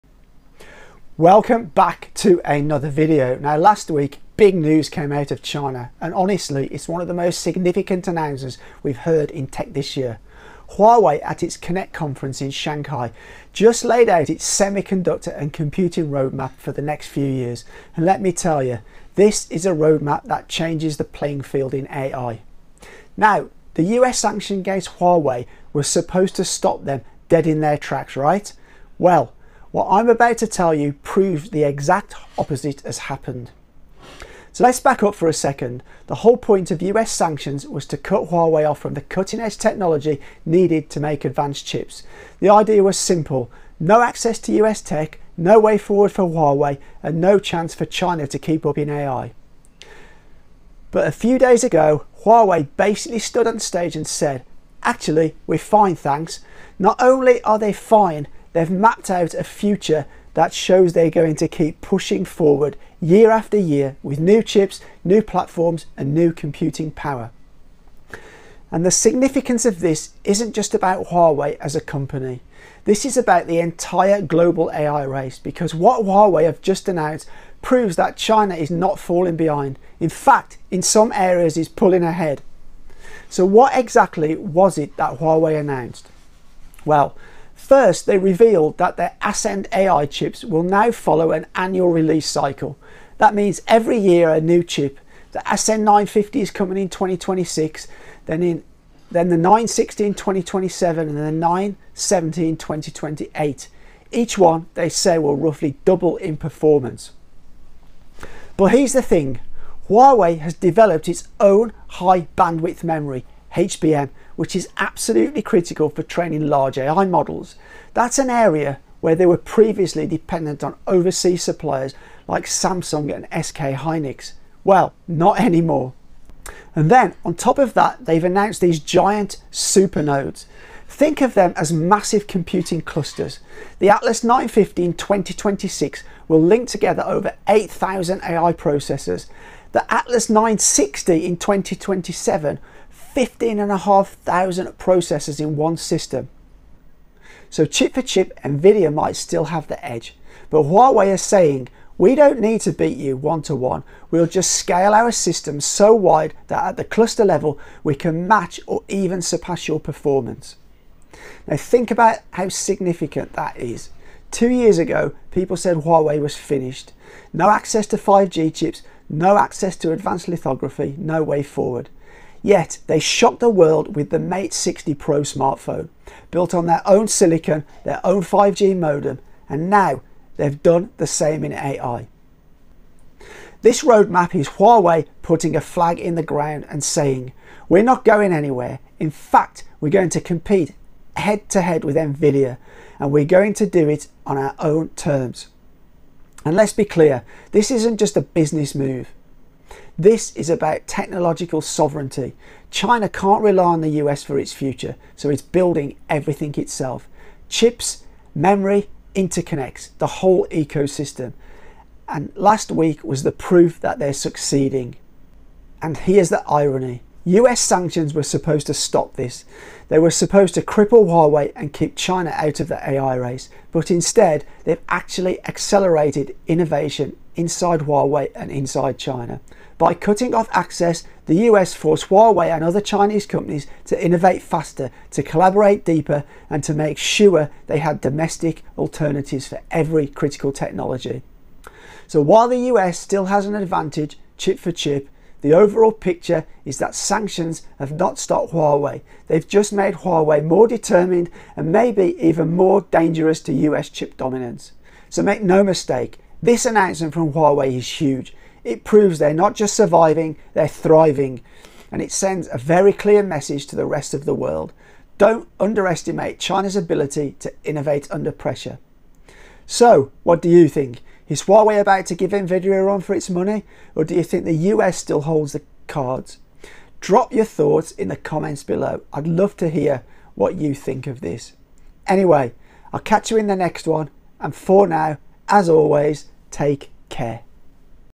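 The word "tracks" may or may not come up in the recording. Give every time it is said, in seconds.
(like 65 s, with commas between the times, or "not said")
27 s.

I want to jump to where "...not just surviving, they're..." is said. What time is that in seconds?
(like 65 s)
259 s.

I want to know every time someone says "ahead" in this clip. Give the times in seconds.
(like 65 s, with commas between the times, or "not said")
82 s.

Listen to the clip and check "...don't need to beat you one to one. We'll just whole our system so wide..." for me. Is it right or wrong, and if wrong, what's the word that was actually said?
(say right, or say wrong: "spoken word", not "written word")
wrong: "scale", not "whole".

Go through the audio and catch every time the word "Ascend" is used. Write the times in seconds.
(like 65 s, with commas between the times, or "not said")
89 s, 95 s.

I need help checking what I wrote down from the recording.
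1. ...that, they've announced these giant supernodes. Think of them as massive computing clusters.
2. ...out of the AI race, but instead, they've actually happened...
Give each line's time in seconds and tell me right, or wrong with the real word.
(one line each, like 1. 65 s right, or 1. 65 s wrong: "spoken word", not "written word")
1. 127 s right
2. 222 s wrong: "accelerated", not "happened".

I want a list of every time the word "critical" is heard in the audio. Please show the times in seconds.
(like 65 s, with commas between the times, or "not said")
115 s, 240 s.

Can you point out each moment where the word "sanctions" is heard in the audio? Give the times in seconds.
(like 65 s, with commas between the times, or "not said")
24 s, 37 s, 217 s, 246 s.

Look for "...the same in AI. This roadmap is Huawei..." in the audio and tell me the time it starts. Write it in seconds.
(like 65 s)
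180 s.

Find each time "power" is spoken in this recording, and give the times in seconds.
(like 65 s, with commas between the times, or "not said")
66 s.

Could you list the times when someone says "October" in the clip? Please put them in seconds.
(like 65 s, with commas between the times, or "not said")
not said.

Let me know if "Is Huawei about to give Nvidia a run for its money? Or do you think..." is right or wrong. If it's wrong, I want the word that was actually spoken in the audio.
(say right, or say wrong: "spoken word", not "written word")
right.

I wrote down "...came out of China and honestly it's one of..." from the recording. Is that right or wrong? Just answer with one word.
right.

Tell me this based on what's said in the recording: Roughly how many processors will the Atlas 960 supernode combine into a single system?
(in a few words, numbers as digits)
15,500.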